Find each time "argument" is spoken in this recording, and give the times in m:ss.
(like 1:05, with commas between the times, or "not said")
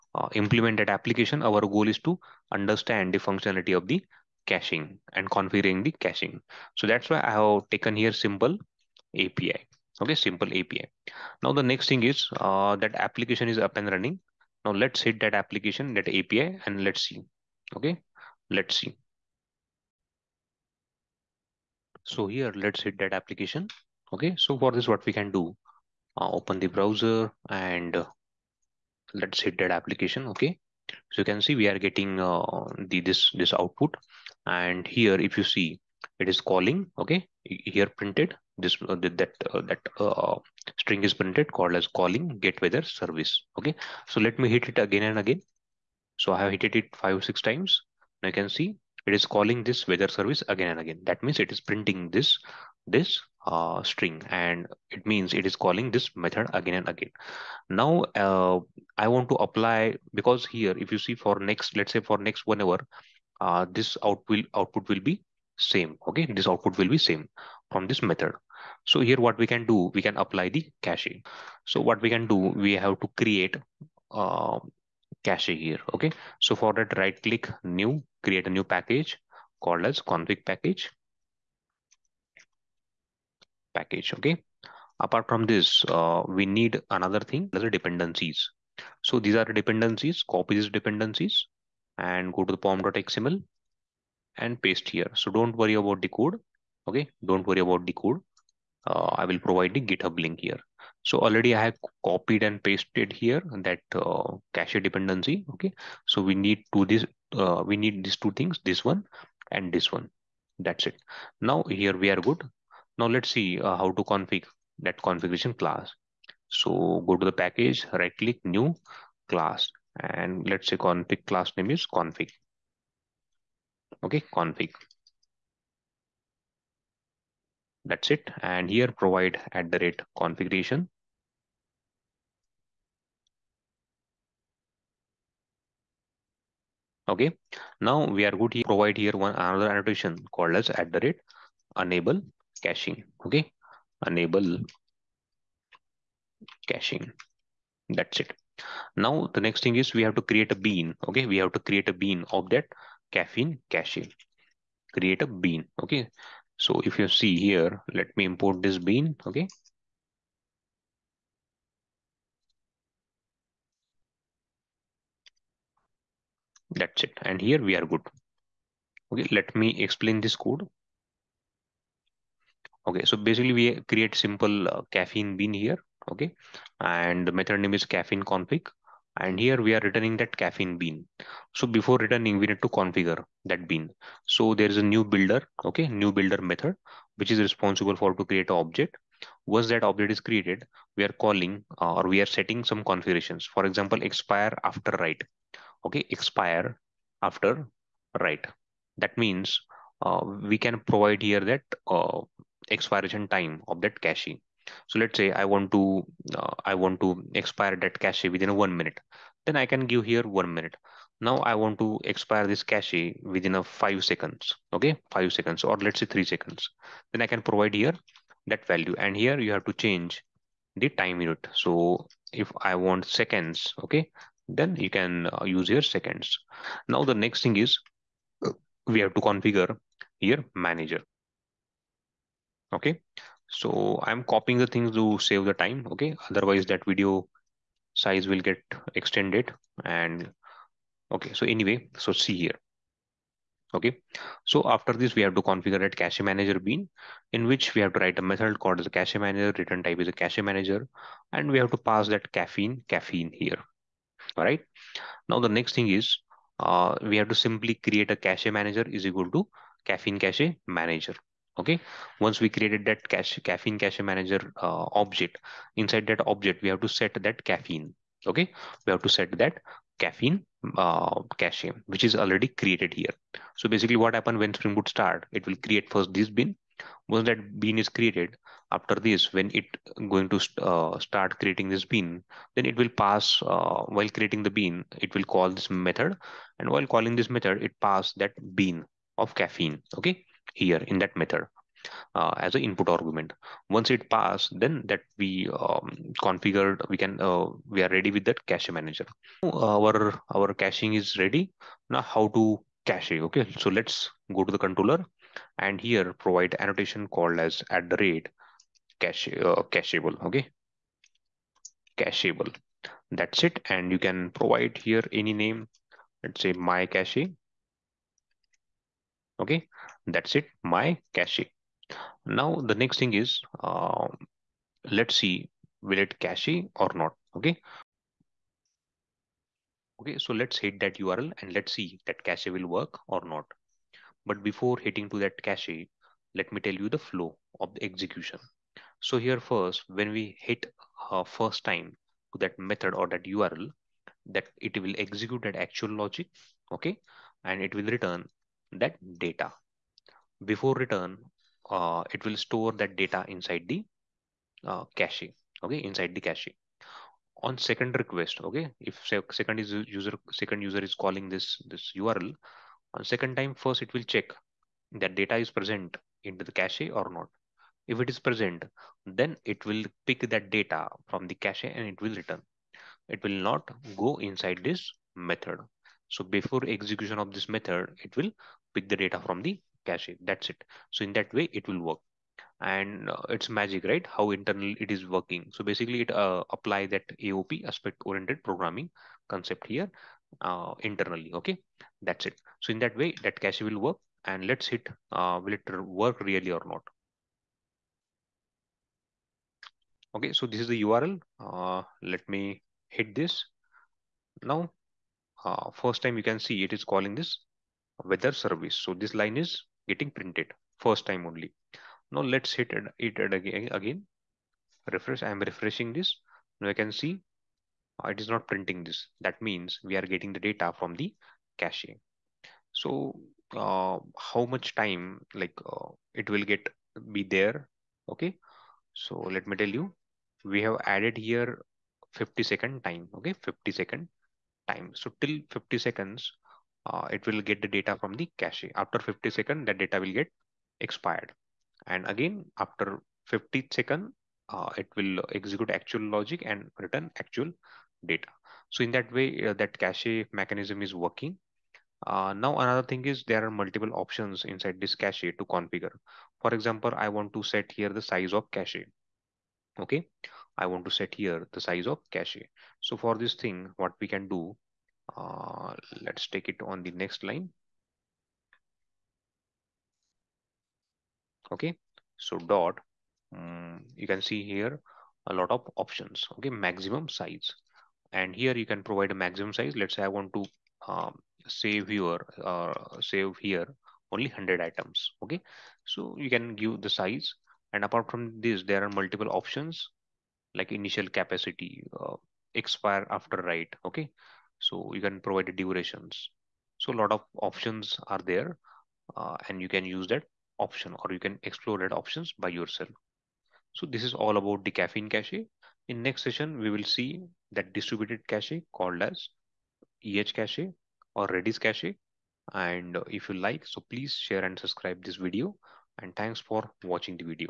4:52.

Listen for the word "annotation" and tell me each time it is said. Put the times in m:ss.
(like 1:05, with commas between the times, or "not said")
2:19, 5:06.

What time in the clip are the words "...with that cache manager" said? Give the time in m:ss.
4:58.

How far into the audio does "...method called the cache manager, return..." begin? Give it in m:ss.
4:08.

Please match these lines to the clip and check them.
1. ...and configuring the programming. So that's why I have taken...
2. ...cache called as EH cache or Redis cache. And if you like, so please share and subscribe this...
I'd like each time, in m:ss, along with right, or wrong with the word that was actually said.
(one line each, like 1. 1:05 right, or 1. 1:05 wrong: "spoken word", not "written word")
1. 0:05 wrong: "caching", not "programming"
2. 8:28 right.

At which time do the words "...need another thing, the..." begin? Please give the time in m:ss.
1:26.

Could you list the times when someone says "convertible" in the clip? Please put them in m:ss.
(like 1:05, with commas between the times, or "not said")
not said.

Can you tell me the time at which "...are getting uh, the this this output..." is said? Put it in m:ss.
0:31.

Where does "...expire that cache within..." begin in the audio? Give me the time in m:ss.
3:27.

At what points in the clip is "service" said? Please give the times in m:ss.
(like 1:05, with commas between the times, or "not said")
0:42, 0:50, 6:48.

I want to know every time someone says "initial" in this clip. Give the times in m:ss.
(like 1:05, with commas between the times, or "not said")
8:10.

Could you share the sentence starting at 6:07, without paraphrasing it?
If it is present, then it will pick that data from the cache and it will return.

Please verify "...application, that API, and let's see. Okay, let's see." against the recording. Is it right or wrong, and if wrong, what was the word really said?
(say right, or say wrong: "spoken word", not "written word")
right.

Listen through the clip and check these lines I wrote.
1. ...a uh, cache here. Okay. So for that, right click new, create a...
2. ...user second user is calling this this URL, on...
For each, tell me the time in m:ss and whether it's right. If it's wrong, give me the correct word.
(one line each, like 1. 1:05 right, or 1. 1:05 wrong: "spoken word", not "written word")
1. 1:14 right
2. 5:59 right.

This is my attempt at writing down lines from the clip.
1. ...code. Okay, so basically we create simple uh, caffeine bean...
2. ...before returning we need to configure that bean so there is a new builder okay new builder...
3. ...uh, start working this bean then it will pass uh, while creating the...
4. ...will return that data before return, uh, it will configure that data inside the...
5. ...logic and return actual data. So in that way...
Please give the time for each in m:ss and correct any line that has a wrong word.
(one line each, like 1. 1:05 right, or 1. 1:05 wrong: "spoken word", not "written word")
1. 2:50 right
2. 3:01 right
3. 4:40 wrong: "creating", not "working"
4. 5:47 wrong: "store", not "configure"
5. 7:26 right.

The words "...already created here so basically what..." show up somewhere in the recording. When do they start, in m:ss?
4:32.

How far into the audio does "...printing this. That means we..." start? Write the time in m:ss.
6:58.